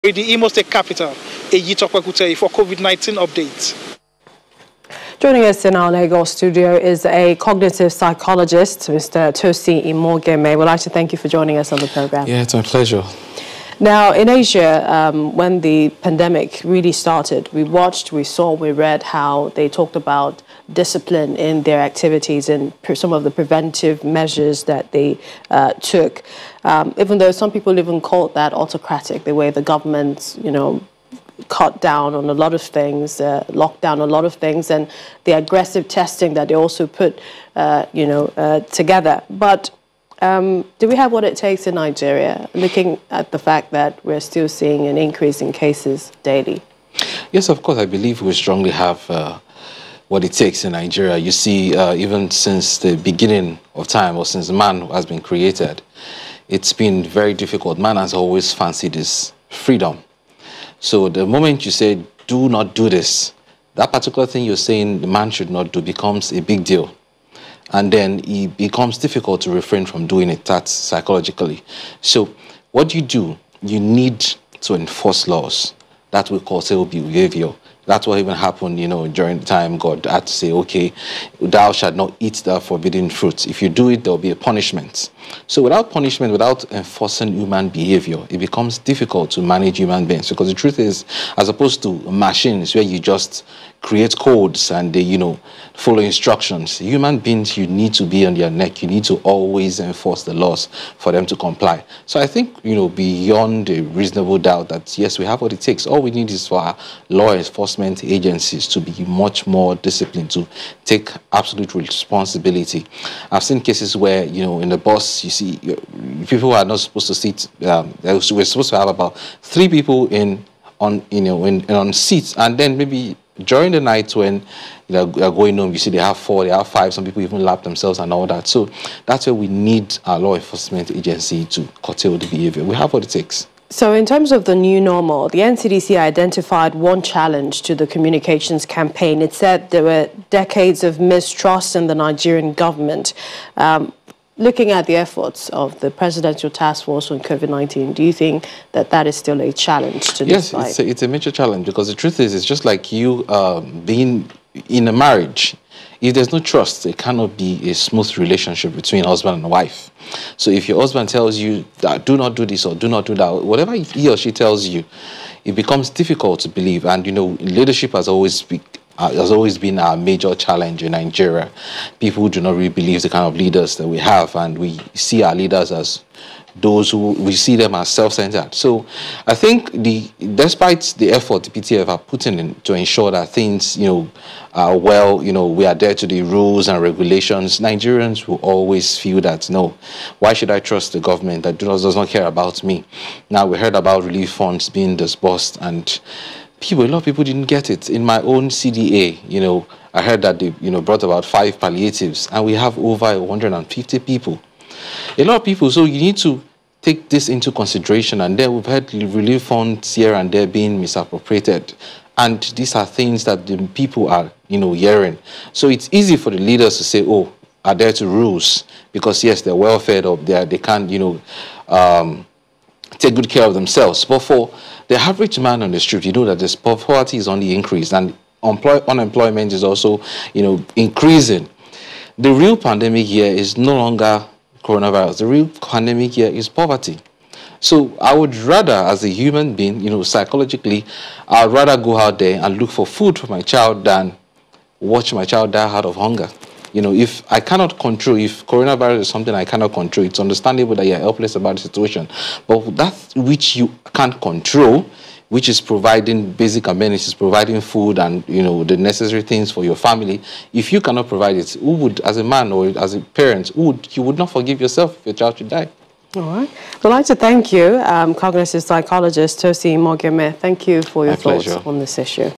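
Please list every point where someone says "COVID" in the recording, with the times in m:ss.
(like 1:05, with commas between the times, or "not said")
0:02, 2:27.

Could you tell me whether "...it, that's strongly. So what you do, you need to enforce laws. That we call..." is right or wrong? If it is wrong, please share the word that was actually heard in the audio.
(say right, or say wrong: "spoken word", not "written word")
wrong: "psychologically", not "strongly".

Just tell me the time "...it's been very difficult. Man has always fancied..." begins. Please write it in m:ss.
0:56.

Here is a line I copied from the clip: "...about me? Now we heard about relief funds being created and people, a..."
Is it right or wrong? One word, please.
wrong.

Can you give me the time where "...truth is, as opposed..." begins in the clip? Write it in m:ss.
1:30.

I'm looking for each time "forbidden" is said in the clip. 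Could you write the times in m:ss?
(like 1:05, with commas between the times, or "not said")
1:22.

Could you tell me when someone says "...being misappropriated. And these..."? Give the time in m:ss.
3:30.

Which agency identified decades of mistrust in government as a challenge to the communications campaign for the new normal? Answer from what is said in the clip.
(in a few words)
NCDC.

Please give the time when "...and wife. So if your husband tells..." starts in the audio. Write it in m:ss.
2:39.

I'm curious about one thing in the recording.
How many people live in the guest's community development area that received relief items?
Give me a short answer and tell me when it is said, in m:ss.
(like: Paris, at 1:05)
Over 150, at 3:22.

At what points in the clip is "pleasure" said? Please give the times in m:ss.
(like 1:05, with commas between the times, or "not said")
0:12, 4:31.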